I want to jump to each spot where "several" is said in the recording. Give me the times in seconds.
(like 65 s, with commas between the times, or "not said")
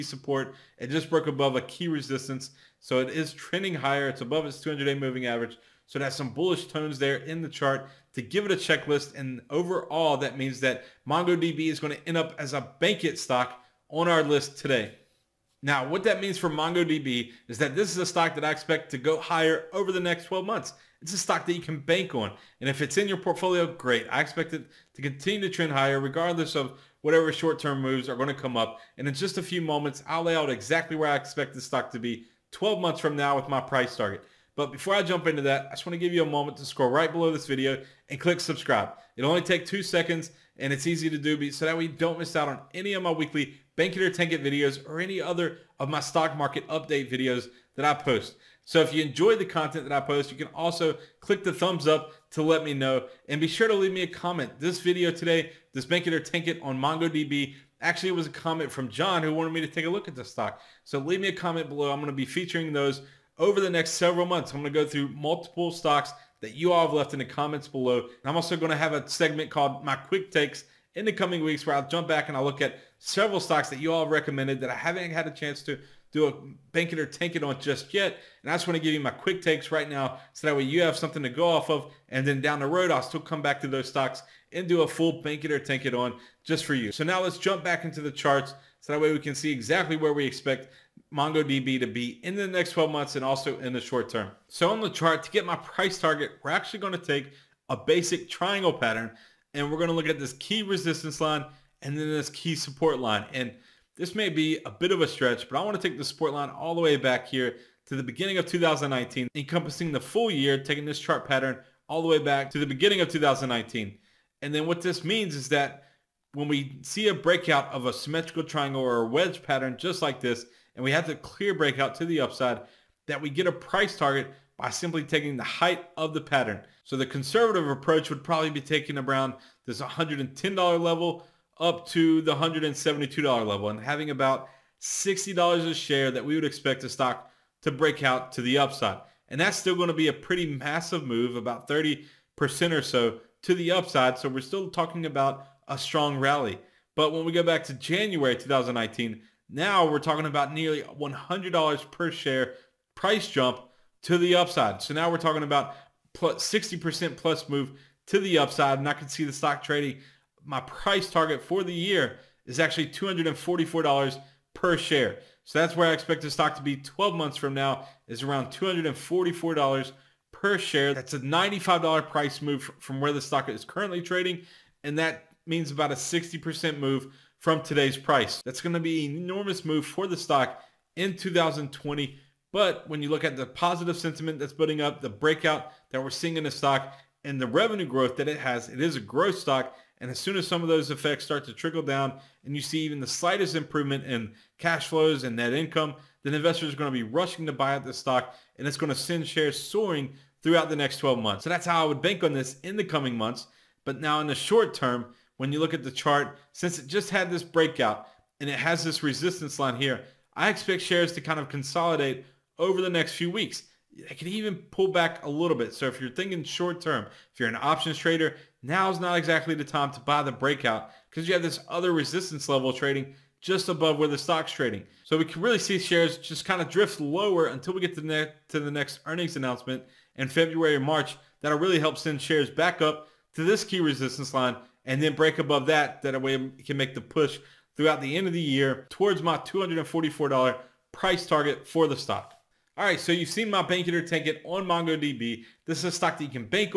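63 s, 72 s.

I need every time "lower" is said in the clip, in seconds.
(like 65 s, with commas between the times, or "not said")
226 s.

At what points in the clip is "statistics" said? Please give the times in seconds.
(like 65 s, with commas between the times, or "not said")
not said.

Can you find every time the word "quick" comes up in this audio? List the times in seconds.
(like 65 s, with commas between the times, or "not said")
69 s, 79 s.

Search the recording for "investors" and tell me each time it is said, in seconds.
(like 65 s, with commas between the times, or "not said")
196 s.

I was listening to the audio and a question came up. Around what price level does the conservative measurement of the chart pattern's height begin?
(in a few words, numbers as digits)
$110.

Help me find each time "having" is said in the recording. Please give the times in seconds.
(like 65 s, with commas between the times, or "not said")
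133 s.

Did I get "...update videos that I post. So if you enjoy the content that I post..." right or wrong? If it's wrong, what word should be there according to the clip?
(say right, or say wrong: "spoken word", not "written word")
right.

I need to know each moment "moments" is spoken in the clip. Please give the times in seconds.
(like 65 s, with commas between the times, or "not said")
29 s, 36 s.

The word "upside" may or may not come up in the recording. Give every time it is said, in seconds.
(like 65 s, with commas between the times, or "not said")
122 s, 138 s, 143 s, 154 s, 158 s.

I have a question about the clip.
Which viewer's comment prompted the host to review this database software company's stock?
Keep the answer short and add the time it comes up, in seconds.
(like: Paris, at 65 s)
John, at 58 s.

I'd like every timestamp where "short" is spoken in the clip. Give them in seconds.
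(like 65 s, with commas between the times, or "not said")
27 s, 93 s, 204 s, 216 s.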